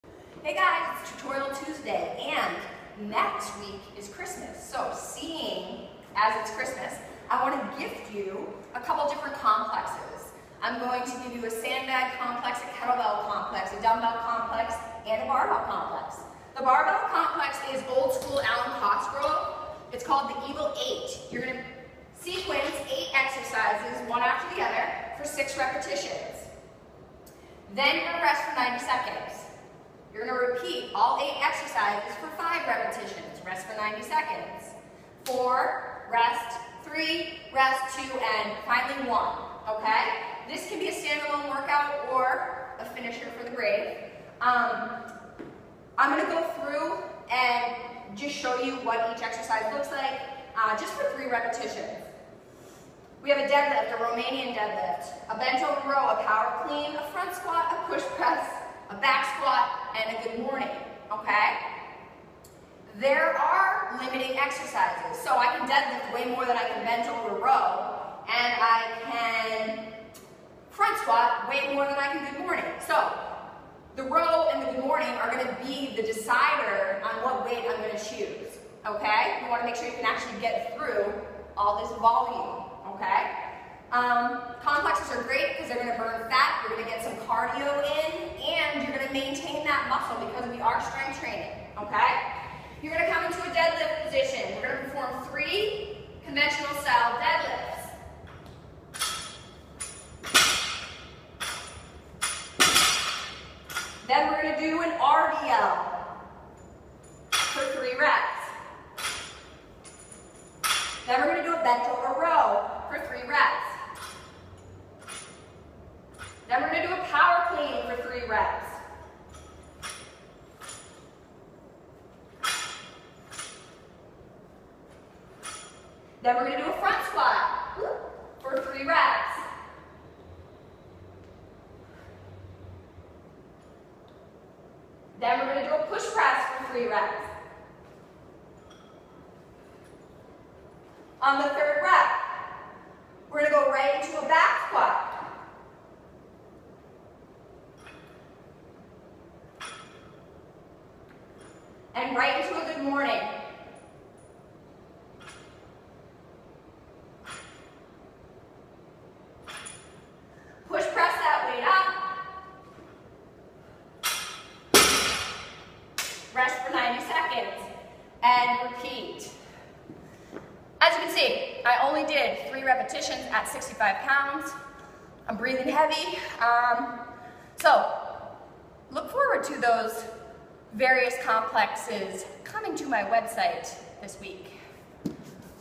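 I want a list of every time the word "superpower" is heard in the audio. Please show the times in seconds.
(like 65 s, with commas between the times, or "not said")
not said.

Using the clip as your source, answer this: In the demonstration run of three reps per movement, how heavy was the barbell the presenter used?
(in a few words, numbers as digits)
65 pounds.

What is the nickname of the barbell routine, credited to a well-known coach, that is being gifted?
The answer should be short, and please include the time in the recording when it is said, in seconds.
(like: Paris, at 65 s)
Evil Eight, at 20 s.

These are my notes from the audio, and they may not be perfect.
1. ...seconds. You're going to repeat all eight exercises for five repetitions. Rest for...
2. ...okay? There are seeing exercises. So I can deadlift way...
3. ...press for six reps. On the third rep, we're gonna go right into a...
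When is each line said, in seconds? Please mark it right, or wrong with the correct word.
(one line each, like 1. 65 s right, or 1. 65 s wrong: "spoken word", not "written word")
1. 28 s right
2. 61 s wrong: "limiting", not "seeing"
3. 136 s wrong: "three", not "six".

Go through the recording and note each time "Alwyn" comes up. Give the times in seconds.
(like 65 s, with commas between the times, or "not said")
18 s.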